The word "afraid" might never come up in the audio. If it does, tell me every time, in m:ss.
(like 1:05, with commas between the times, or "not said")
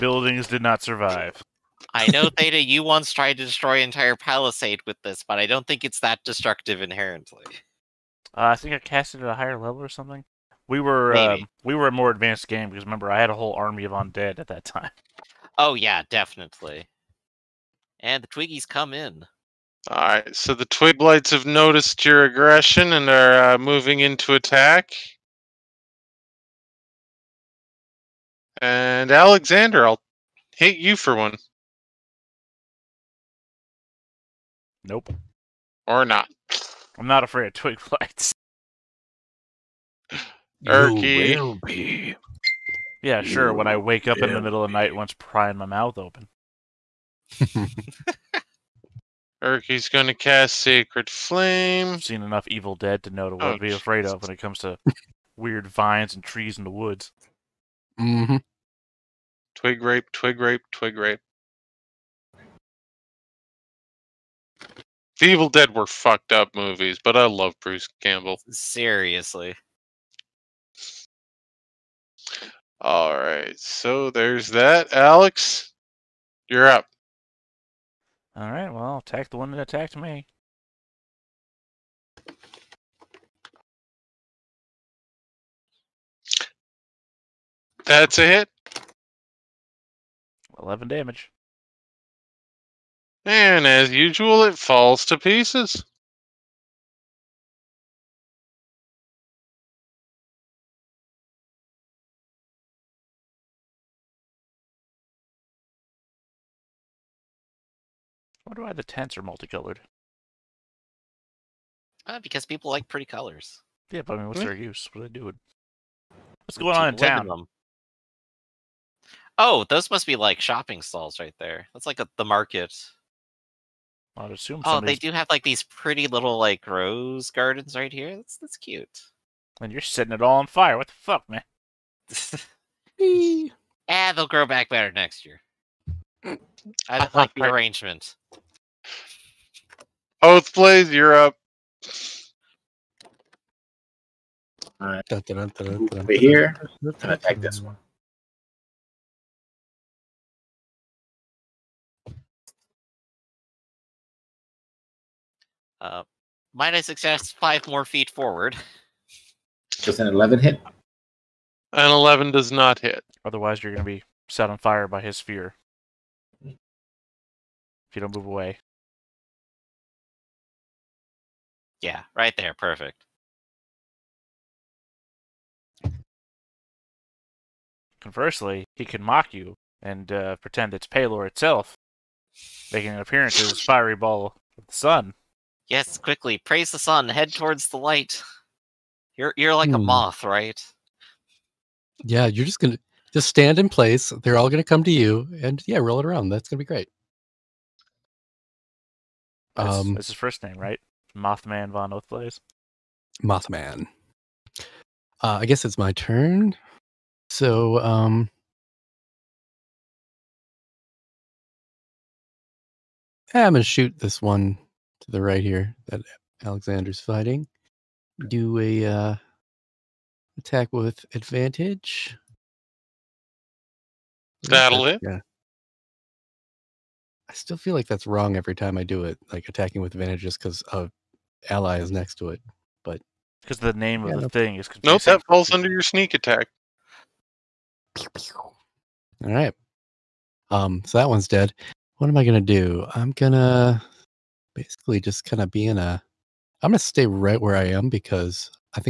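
0:37, 0:53.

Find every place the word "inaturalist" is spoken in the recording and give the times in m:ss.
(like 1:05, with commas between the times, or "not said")
not said.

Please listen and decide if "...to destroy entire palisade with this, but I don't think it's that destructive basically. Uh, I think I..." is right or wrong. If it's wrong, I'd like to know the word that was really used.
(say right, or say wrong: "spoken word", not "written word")
wrong: "inherently", not "basically".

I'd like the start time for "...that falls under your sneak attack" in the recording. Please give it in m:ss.
3:55.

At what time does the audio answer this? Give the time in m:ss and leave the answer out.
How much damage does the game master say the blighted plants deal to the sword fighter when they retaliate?
0:30.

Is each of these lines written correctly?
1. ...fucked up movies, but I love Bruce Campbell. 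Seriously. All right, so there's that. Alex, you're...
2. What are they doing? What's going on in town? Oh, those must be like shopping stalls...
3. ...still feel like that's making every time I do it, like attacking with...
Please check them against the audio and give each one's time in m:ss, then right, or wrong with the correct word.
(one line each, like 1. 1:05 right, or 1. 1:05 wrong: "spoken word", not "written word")
1. 1:05 right
2. 1:54 right
3. 3:47 wrong: "wrong", not "making".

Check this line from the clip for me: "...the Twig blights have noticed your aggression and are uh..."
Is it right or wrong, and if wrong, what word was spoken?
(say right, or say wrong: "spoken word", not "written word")
right.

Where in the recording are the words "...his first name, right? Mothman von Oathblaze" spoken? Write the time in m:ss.
3:20.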